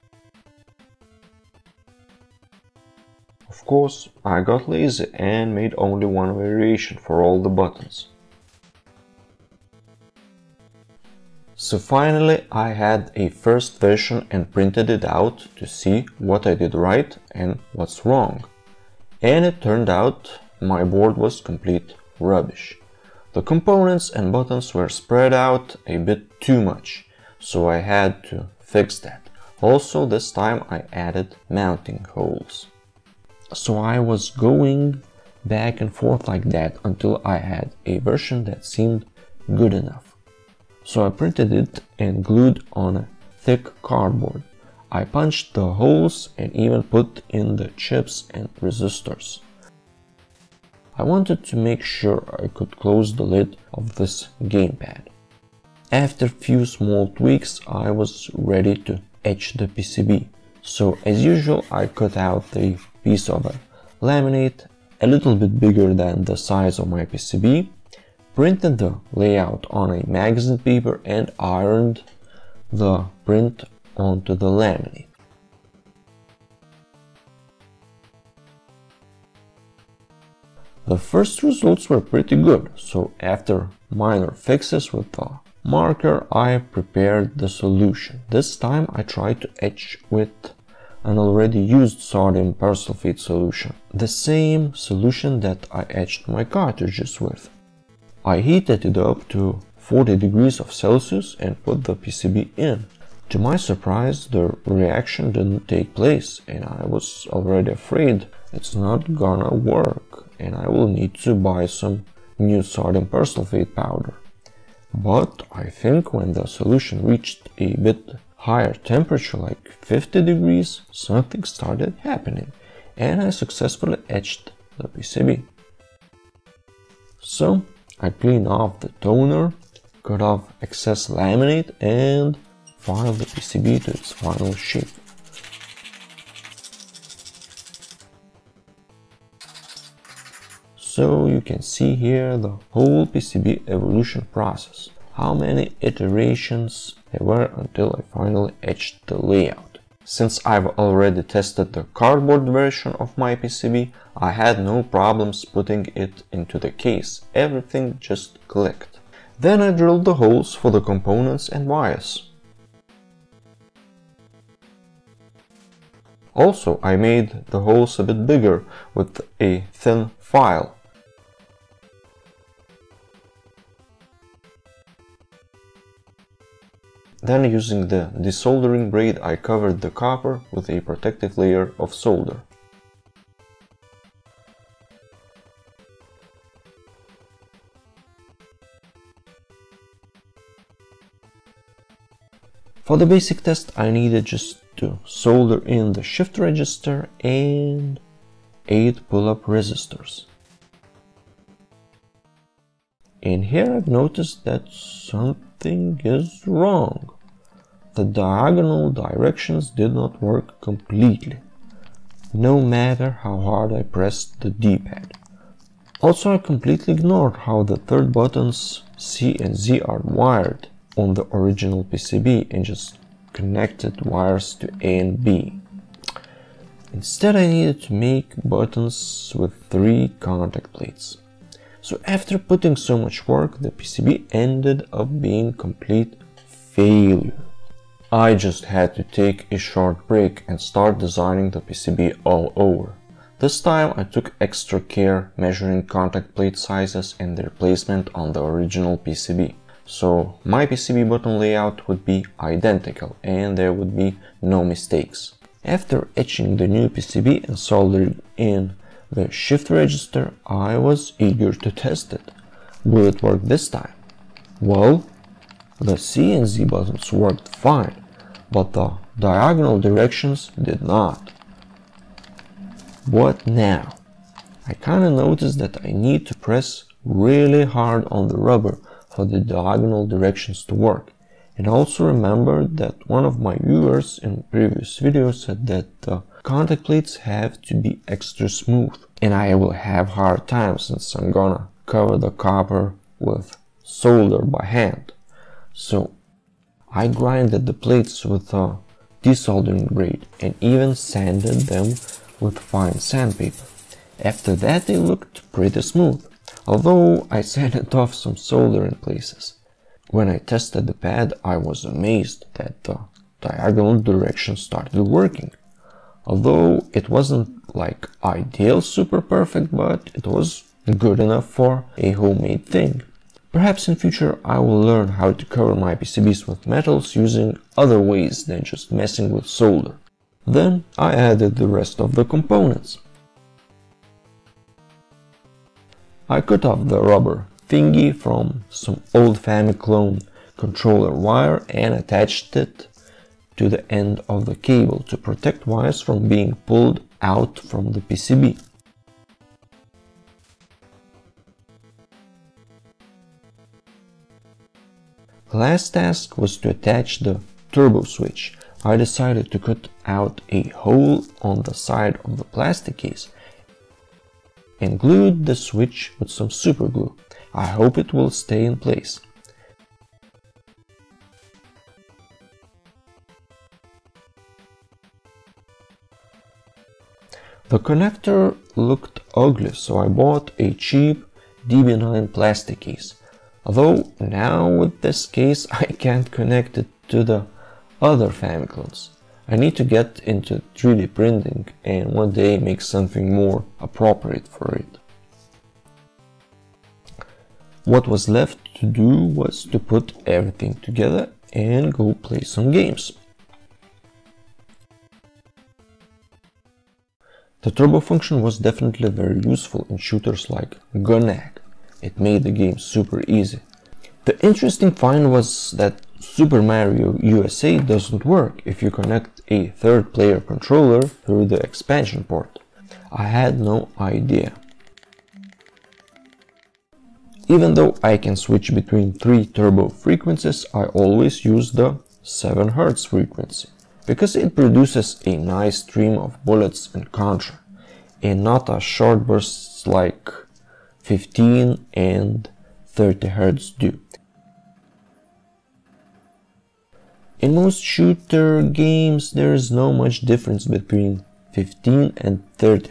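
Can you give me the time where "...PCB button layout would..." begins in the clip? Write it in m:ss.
4:10.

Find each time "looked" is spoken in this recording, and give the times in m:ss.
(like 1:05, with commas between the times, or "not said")
5:04, 6:18.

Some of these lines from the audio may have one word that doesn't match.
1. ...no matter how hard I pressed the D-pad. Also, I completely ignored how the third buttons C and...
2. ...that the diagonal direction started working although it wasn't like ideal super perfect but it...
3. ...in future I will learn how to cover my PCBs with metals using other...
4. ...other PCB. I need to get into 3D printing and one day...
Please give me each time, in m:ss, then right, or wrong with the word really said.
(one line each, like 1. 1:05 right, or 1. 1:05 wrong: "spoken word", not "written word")
1. 3:32 right
2. 5:12 right
3. 5:23 right
4. 6:28 wrong: "Famiclones", not "PCB".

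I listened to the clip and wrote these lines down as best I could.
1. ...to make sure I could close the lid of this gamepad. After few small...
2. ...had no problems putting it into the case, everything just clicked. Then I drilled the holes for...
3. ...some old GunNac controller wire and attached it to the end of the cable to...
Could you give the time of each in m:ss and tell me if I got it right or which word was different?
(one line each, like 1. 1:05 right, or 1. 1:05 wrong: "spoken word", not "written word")
1. 0:51 right
2. 2:34 right
3. 5:38 wrong: "Famiclone", not "GunNac".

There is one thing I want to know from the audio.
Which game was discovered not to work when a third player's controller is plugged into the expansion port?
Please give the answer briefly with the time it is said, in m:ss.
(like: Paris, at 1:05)
Super Mario USA, at 6:56.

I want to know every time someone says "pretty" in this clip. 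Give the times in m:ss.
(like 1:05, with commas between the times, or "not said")
1:22, 5:05.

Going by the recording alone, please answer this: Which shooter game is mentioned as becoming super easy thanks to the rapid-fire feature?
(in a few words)
Gun-Nac.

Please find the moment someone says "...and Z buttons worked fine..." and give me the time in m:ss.
4:26.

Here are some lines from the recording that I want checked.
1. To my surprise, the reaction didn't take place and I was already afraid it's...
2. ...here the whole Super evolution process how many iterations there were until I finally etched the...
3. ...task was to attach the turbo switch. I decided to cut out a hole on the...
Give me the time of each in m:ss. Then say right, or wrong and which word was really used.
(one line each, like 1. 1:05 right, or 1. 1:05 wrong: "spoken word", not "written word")
1. 1:43 right
2. 2:21 wrong: "PCB", not "Super"
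3. 5:55 right.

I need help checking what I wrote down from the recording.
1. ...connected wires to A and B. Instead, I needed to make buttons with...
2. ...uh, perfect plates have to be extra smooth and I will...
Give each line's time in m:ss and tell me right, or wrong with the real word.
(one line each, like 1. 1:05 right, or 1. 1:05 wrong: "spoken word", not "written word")
1. 3:43 right
2. 4:46 wrong: "contact", not "perfect".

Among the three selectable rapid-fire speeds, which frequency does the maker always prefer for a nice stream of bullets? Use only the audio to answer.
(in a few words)
7Hz.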